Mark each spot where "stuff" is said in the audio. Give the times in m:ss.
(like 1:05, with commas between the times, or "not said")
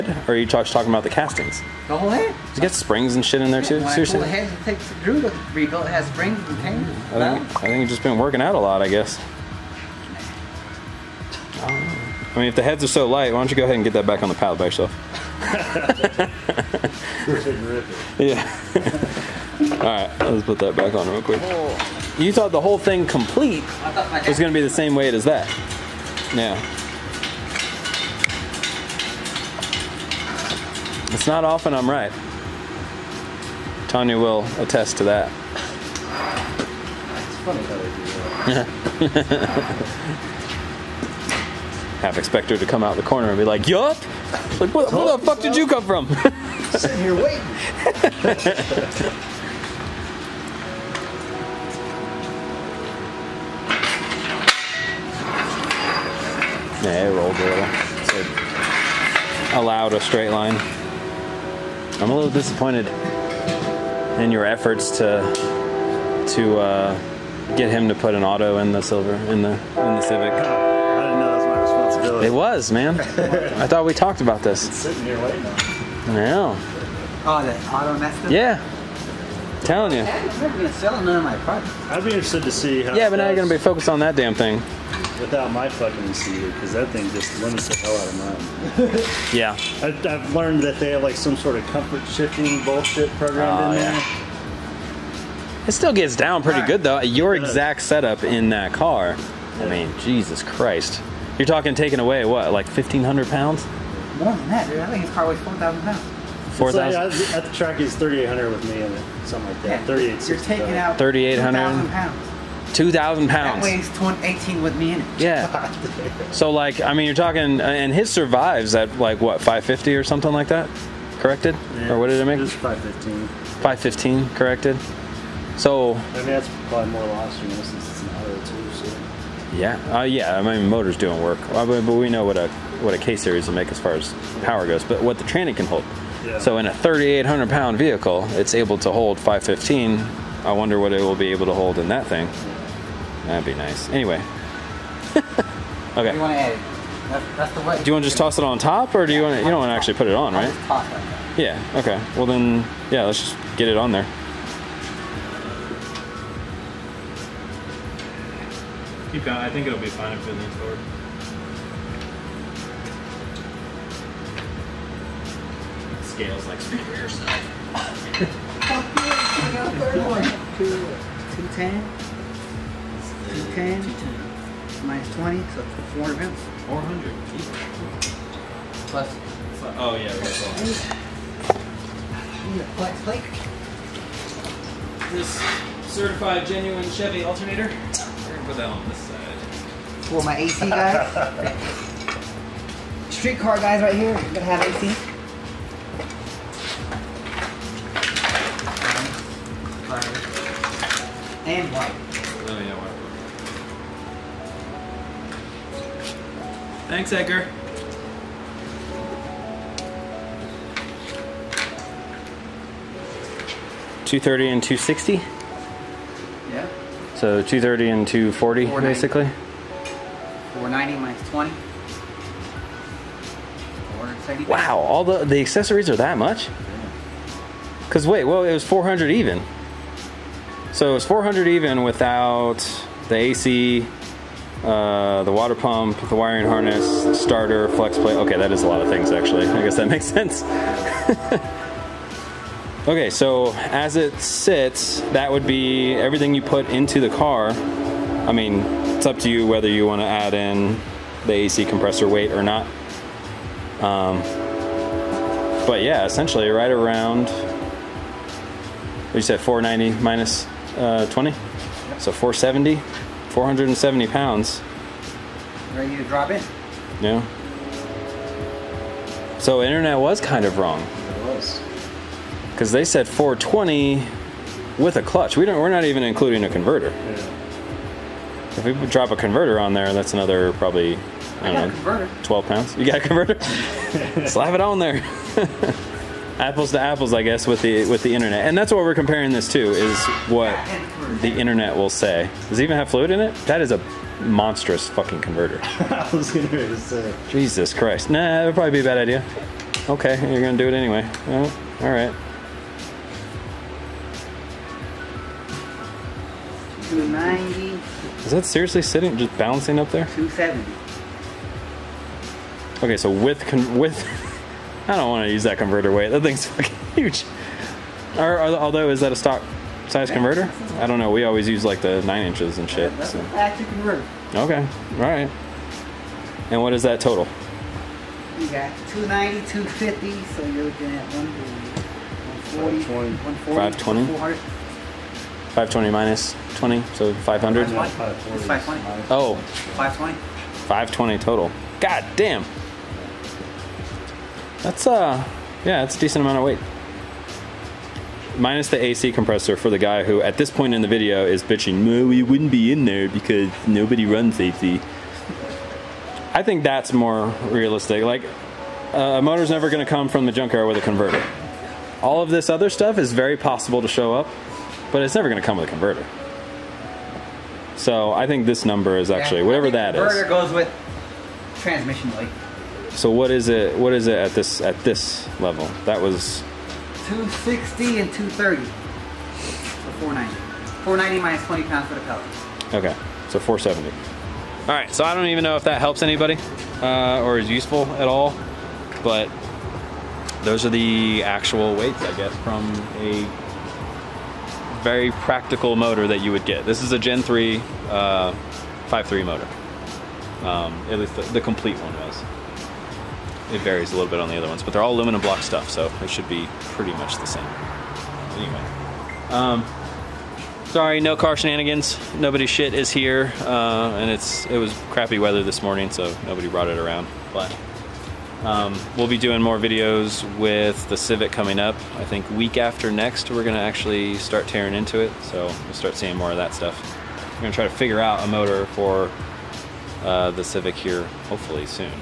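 6:02, 6:45, 7:06.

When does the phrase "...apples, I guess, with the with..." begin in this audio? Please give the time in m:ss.
4:46.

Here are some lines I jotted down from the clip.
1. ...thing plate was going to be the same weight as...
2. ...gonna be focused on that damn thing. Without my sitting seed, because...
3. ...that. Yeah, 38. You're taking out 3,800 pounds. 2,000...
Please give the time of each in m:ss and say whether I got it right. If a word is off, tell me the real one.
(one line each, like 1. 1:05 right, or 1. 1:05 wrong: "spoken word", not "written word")
1. 0:22 wrong: "complete", not "plate"
2. 1:23 wrong: "fucking", not "sitting"
3. 1:49 right.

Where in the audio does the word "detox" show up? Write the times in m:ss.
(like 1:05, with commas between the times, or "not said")
not said.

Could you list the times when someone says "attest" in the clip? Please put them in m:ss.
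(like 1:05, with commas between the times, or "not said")
0:34.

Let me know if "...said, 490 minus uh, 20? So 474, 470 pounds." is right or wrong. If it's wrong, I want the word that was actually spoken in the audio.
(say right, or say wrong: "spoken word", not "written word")
wrong: "470", not "474".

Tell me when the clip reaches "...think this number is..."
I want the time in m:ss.
6:08.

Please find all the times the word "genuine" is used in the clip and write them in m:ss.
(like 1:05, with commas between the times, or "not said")
3:06.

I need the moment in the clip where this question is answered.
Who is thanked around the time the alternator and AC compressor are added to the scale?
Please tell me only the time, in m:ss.
3:26.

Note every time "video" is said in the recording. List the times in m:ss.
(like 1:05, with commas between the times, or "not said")
5:50, 6:59.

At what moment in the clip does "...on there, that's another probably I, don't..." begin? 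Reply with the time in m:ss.
4:39.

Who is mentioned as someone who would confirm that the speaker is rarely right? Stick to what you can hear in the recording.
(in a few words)
Tanya.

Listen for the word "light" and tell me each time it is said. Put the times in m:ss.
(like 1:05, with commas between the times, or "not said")
0:13, 6:12.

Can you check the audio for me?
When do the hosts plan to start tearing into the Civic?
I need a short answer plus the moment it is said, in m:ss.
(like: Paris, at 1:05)
week after next, at 7:02.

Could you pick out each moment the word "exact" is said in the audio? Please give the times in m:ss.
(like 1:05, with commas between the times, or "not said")
1:37.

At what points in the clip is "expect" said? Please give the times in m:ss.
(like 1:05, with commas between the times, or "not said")
0:42.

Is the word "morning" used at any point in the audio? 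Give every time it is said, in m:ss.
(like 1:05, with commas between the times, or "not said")
6:55.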